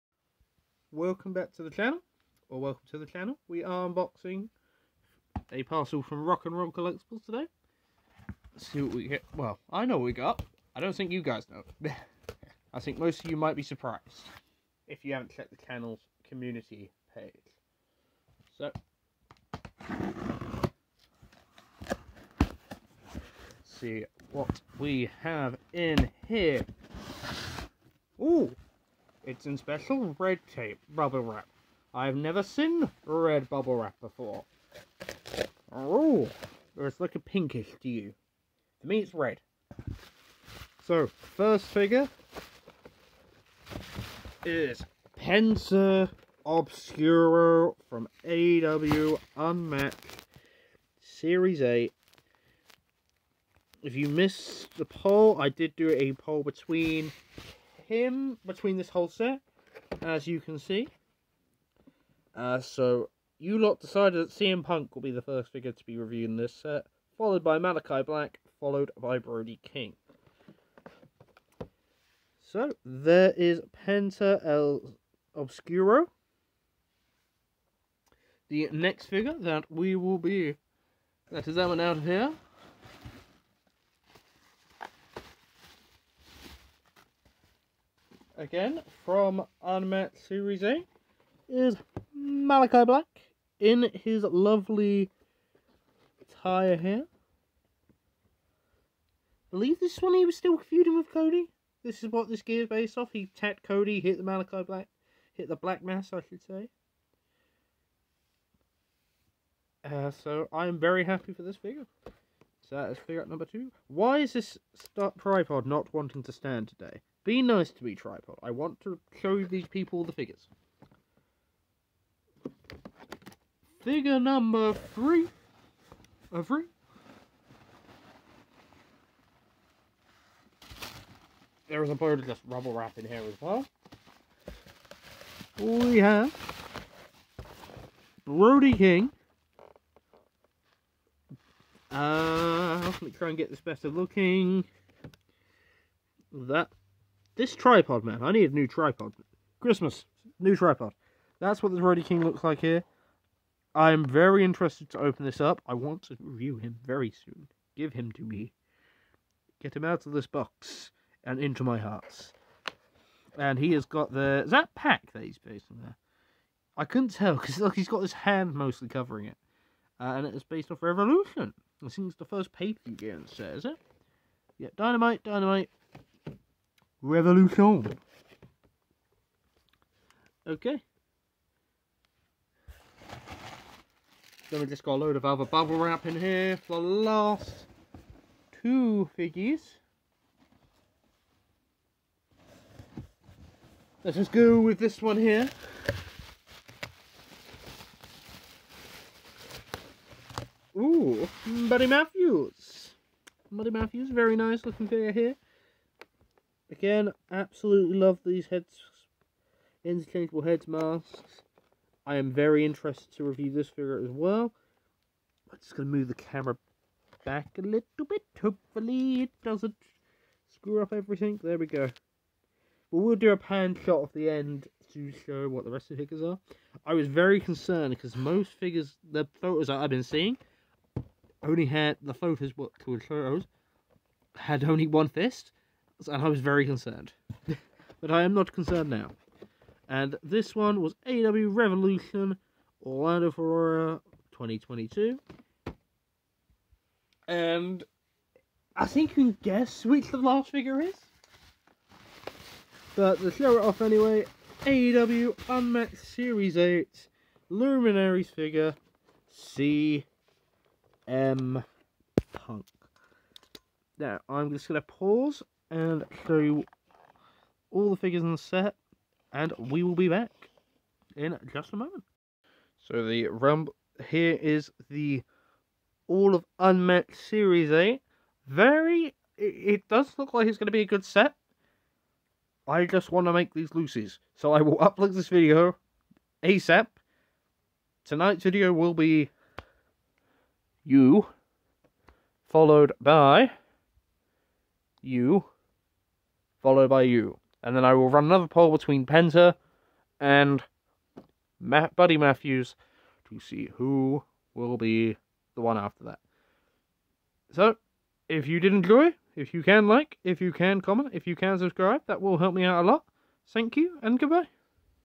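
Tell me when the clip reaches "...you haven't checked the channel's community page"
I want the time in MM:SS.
00:15.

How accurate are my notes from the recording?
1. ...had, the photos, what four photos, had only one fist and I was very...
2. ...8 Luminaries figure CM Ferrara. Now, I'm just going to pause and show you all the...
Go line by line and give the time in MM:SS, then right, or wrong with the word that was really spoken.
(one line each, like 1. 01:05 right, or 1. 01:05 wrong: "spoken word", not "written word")
1. 03:51 wrong: "two", not "four"
2. 04:16 wrong: "Punk", not "Ferrara".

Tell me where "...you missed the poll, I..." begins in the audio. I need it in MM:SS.
00:53.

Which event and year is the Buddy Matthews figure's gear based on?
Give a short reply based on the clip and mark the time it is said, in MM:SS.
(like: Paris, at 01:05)
AEW Revolution 2022, at 04:01.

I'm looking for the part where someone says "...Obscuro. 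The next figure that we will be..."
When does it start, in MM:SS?
01:15.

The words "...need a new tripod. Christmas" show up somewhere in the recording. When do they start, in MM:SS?
02:28.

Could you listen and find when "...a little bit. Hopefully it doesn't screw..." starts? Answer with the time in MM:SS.
03:37.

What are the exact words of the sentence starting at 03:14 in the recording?
Let's just go with this one here.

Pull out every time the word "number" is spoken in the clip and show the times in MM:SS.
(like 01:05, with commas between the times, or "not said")
01:53, 02:04.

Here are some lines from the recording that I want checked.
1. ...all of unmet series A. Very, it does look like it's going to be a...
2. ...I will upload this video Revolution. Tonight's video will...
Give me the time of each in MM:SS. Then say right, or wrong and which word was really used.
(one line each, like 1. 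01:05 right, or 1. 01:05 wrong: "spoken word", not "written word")
1. 04:36 right
2. 04:44 wrong: "ASAP", not "Revolution".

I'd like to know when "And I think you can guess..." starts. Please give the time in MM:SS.
04:07.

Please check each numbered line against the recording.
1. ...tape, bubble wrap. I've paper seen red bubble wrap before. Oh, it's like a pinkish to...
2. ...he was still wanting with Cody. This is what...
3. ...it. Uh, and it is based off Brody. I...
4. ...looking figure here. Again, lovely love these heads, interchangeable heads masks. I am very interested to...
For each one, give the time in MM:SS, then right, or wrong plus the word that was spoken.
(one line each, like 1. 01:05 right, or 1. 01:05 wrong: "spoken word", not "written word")
1. 00:30 wrong: "never", not "paper"
2. 01:40 wrong: "feuding", not "wanting"
3. 02:49 wrong: "Revolution", not "Brody"
4. 03:24 wrong: "absolutely", not "lovely".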